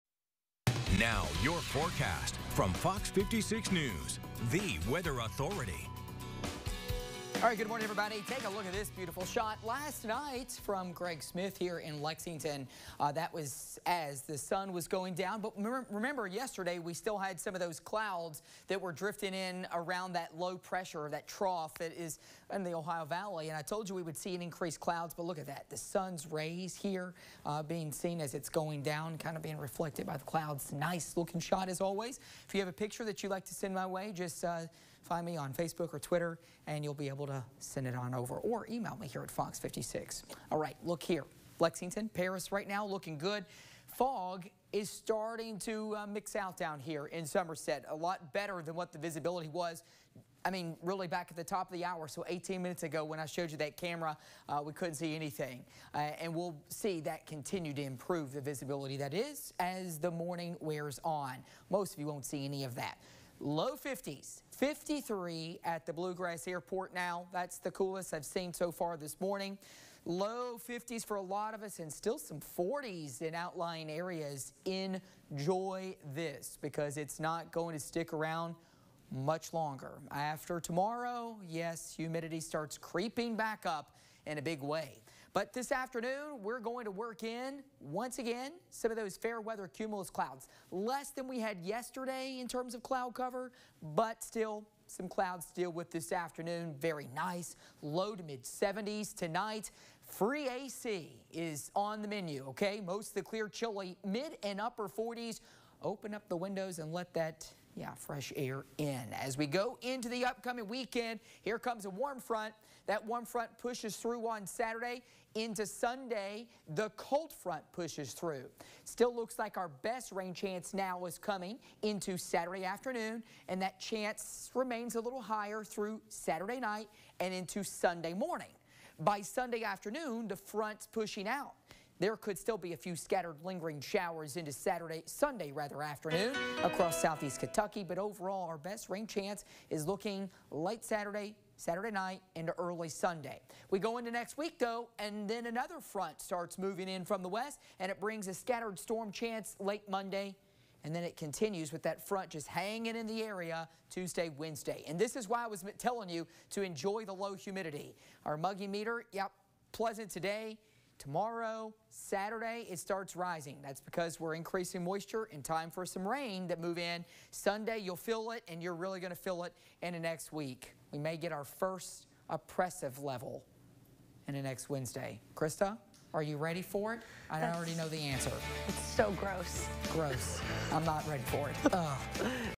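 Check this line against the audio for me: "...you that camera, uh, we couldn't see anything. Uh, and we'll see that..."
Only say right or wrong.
right.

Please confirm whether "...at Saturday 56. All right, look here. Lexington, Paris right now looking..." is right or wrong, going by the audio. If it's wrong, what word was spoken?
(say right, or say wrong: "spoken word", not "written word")
wrong: "Fox", not "Saturday".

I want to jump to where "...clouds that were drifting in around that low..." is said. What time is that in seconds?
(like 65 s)
17 s.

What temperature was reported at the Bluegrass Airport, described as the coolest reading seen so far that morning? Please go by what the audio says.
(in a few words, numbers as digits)
53.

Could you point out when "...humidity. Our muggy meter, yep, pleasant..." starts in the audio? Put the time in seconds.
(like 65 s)
157 s.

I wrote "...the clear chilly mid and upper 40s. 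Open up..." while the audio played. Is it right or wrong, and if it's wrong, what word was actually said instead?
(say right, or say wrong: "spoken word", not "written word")
right.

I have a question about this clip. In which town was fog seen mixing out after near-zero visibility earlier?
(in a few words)
Somerset.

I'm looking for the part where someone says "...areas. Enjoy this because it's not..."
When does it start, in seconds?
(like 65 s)
73 s.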